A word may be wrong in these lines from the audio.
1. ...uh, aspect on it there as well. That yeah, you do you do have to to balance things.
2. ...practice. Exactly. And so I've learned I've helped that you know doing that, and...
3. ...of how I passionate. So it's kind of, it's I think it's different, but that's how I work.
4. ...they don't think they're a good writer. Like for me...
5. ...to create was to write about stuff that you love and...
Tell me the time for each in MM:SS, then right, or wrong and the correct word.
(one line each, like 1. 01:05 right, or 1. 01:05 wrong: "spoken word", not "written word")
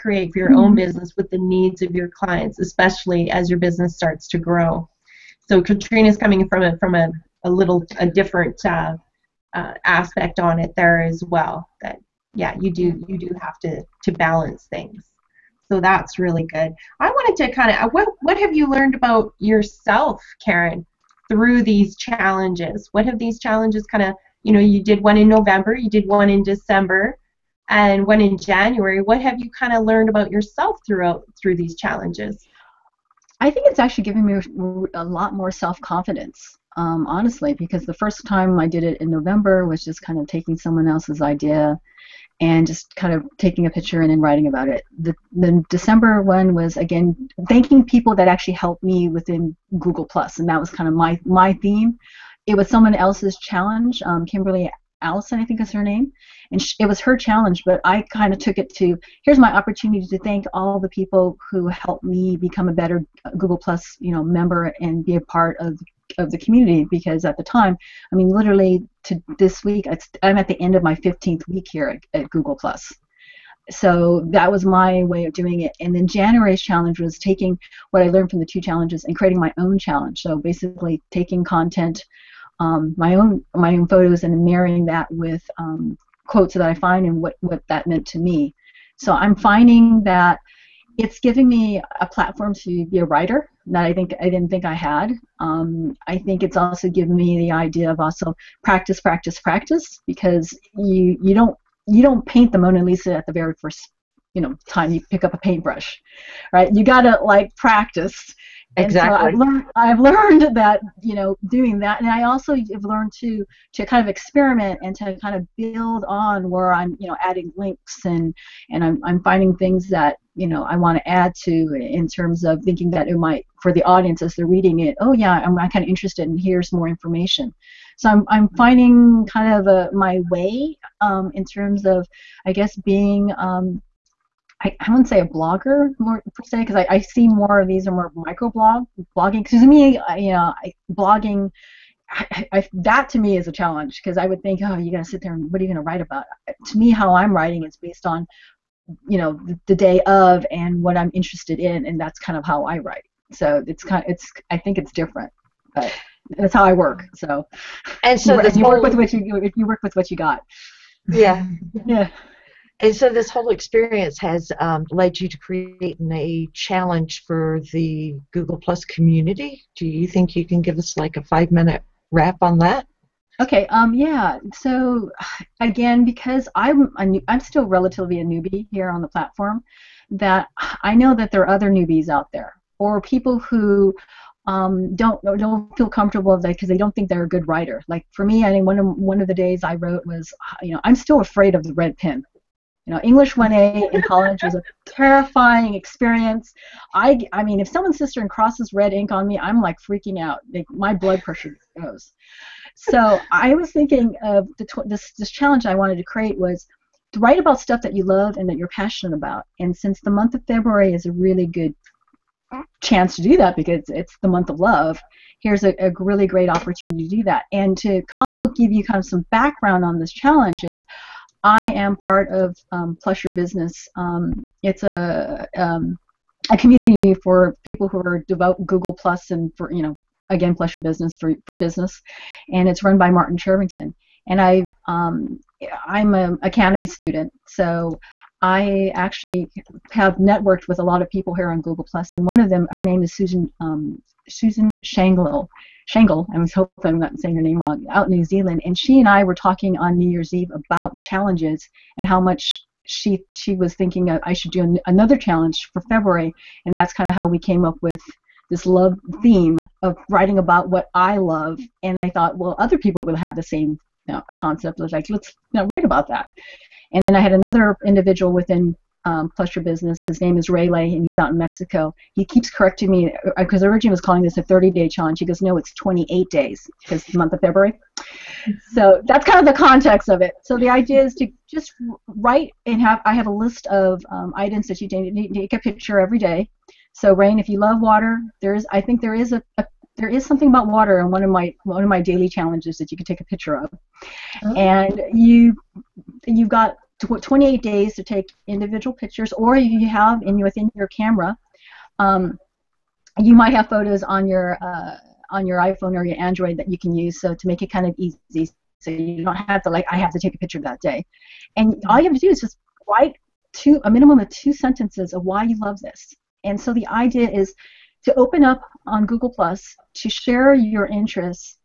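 1. 00:09 right
2. 01:47 wrong: "learned", not "helped"
3. 02:32 wrong: "write", not "passionate"
4. 03:06 right
5. 03:25 right.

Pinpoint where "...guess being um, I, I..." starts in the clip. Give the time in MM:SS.
02:12.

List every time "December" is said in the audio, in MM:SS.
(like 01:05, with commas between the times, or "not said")
00:26, 00:45.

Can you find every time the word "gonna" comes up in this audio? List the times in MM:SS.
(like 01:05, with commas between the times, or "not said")
02:25.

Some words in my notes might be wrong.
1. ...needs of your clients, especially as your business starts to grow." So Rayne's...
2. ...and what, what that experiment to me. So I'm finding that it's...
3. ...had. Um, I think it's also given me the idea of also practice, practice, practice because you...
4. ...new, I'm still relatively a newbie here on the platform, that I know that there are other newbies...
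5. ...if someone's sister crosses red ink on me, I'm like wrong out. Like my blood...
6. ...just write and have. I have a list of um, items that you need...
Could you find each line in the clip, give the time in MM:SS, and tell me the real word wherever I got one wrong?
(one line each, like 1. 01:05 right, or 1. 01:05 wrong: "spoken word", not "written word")
1. 00:01 wrong: "Katrina", not "Rayne"
2. 01:27 wrong: "meant", not "experiment"
3. 01:34 right
4. 02:57 right
5. 03:17 wrong: "freaking", not "wrong"
6. 04:41 right.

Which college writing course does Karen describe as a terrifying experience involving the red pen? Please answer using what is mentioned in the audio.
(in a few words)
English 1A.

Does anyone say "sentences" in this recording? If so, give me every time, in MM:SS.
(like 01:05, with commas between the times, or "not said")
05:14.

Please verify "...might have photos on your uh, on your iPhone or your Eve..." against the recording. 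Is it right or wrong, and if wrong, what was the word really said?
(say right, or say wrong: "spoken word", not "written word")
wrong: "Android", not "Eve".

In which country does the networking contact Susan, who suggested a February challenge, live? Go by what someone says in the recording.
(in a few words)
New Zealand.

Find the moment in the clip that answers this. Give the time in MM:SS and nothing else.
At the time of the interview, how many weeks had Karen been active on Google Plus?
01:10.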